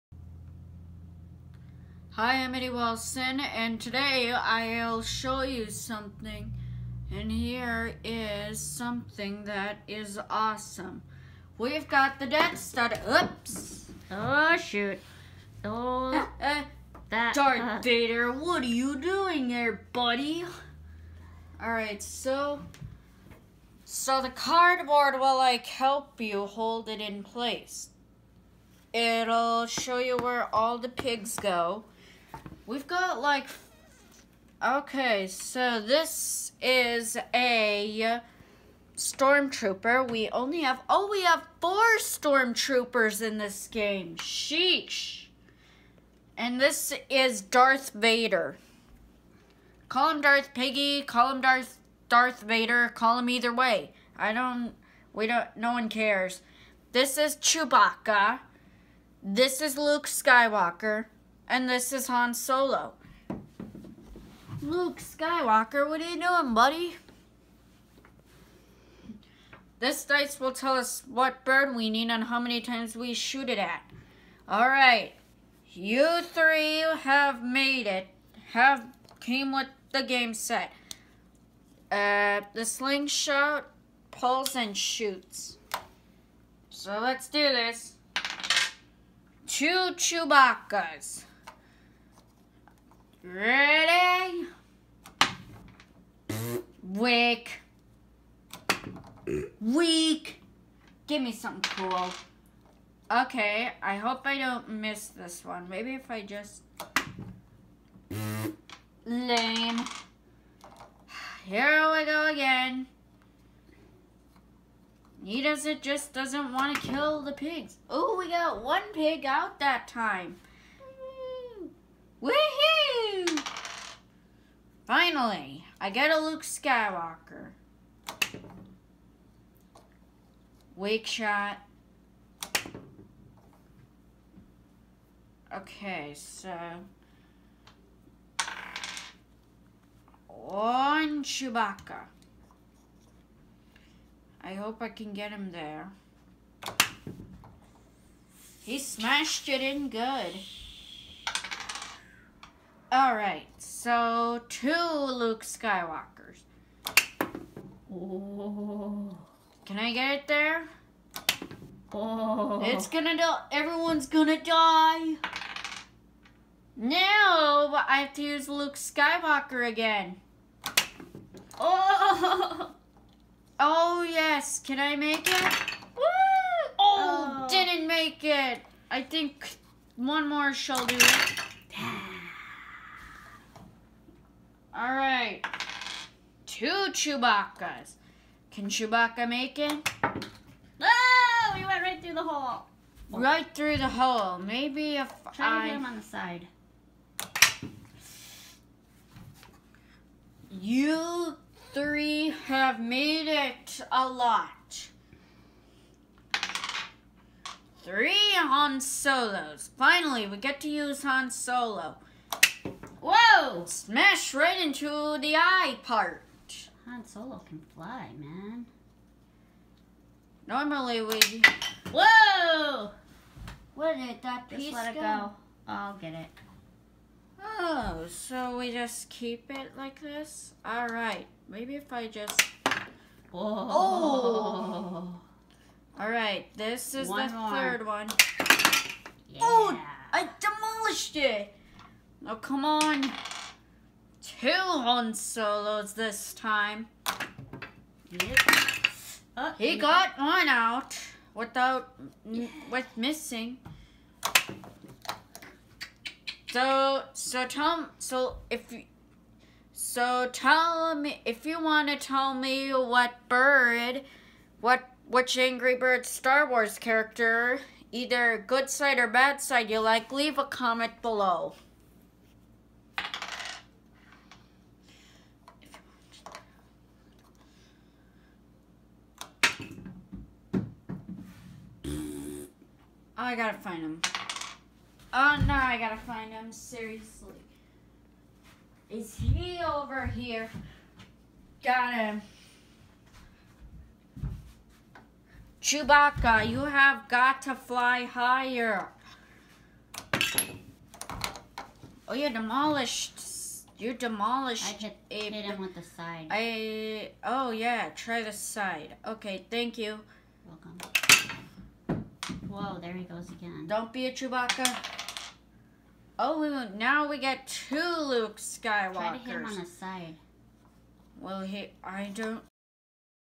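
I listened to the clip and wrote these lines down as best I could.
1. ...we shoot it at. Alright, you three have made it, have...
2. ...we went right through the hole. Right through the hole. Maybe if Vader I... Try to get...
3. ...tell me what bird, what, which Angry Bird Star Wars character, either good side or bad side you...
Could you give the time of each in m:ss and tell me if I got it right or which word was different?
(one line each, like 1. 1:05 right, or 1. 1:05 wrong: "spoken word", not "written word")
1. 1:12 right
2. 3:11 wrong: "Try", not "Vader"
3. 4:21 right.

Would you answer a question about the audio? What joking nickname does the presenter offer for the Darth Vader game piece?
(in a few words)
Darth Piggy.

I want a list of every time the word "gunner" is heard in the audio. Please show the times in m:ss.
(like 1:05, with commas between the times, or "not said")
not said.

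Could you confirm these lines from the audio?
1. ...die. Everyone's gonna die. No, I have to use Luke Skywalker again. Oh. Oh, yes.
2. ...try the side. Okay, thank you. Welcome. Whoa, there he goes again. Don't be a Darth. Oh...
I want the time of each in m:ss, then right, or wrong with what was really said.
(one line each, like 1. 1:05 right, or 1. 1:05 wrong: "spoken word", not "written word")
1. 2:43 right
2. 5:07 wrong: "Chewbacca", not "Darth".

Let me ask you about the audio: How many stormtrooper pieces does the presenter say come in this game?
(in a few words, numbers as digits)
4.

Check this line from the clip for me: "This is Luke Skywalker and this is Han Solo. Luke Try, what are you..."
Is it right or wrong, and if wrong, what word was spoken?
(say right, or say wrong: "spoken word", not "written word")
wrong: "Skywalker", not "Try".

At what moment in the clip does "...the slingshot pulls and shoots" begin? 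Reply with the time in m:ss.
1:22.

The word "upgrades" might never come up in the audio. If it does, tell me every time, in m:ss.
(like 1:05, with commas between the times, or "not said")
not said.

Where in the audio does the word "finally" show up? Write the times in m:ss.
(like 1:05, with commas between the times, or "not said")
2:05, 3:29.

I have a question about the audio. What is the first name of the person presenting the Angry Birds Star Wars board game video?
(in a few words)
Eddie.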